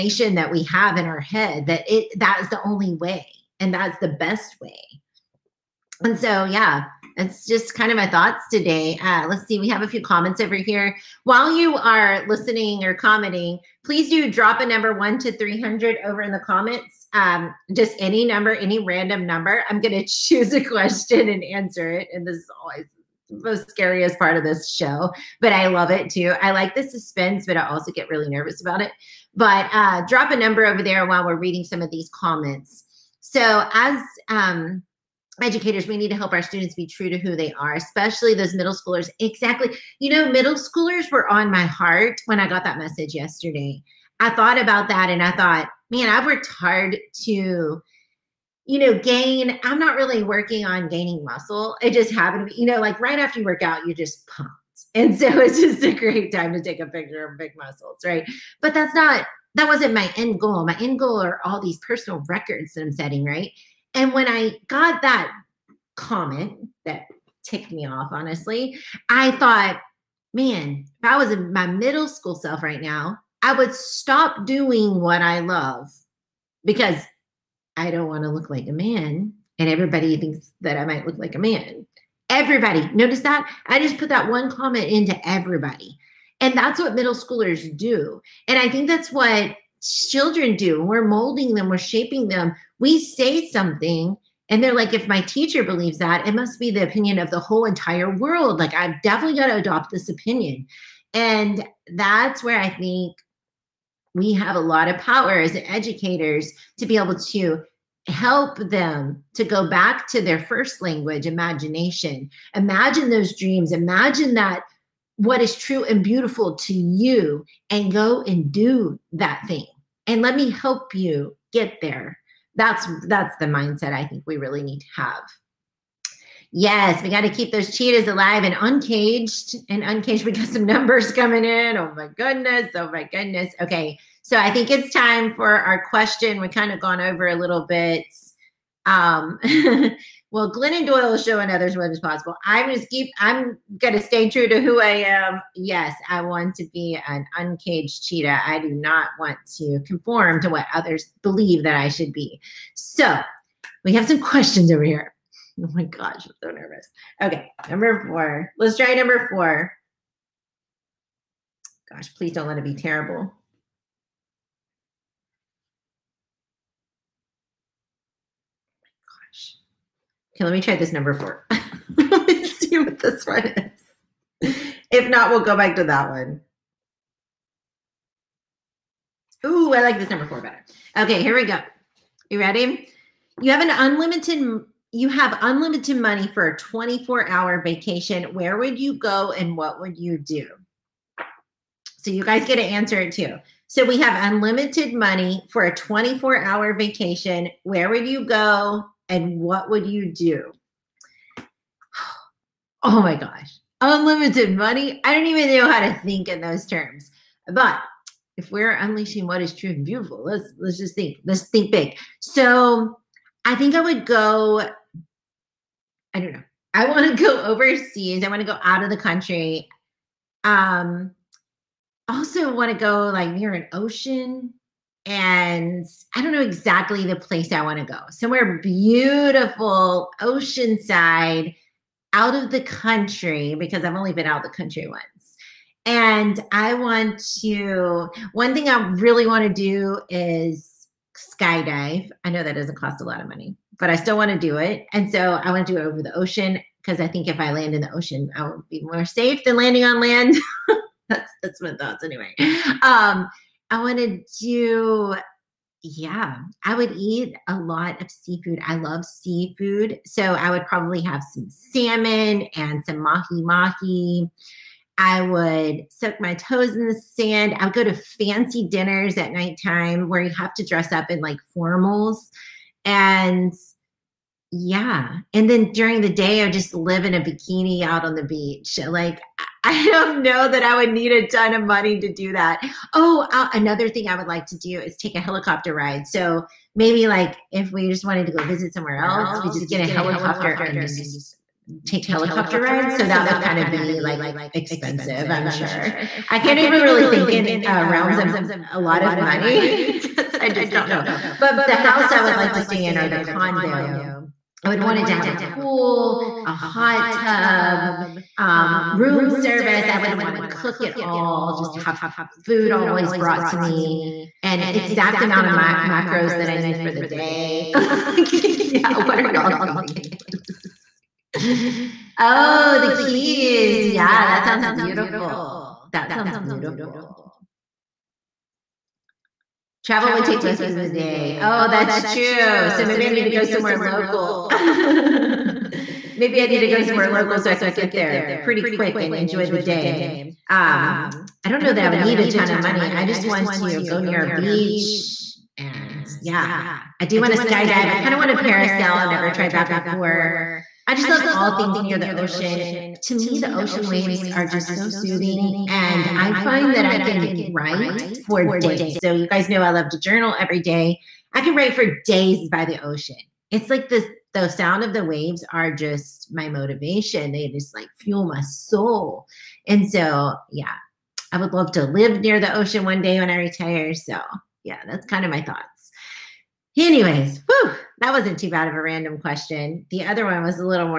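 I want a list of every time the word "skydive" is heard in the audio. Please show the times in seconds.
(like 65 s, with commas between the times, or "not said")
241 s, 347 s.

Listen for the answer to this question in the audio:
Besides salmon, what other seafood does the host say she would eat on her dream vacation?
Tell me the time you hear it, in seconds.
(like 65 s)
263 s.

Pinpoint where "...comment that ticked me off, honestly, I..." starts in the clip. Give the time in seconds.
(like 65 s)
65 s.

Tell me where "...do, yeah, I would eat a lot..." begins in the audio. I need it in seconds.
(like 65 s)
254 s.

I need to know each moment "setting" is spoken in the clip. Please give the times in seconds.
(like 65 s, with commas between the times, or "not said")
62 s.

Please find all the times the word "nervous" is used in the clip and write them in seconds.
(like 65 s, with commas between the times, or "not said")
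28 s, 156 s.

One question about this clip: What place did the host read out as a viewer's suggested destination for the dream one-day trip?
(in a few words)
The Keys.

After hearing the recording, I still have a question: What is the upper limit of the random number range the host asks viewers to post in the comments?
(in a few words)
300.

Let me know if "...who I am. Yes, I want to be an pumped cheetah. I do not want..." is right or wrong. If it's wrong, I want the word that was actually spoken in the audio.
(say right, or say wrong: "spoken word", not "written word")
wrong: "uncaged", not "pumped".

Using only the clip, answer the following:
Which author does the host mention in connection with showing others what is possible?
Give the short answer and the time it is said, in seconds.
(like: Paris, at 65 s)
Glennon Doyle, at 140 s.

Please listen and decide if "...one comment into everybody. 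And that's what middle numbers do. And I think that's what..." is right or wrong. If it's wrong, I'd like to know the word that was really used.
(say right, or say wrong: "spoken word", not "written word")
wrong: "schoolers", not "numbers".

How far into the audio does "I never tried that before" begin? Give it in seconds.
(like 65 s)
349 s.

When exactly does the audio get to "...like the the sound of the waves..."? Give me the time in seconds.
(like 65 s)
363 s.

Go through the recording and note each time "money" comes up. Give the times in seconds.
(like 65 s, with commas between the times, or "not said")
185 s, 194 s, 204 s, 243 s, 281 s, 299 s, 342 s.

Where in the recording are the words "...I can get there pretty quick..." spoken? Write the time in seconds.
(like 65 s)
337 s.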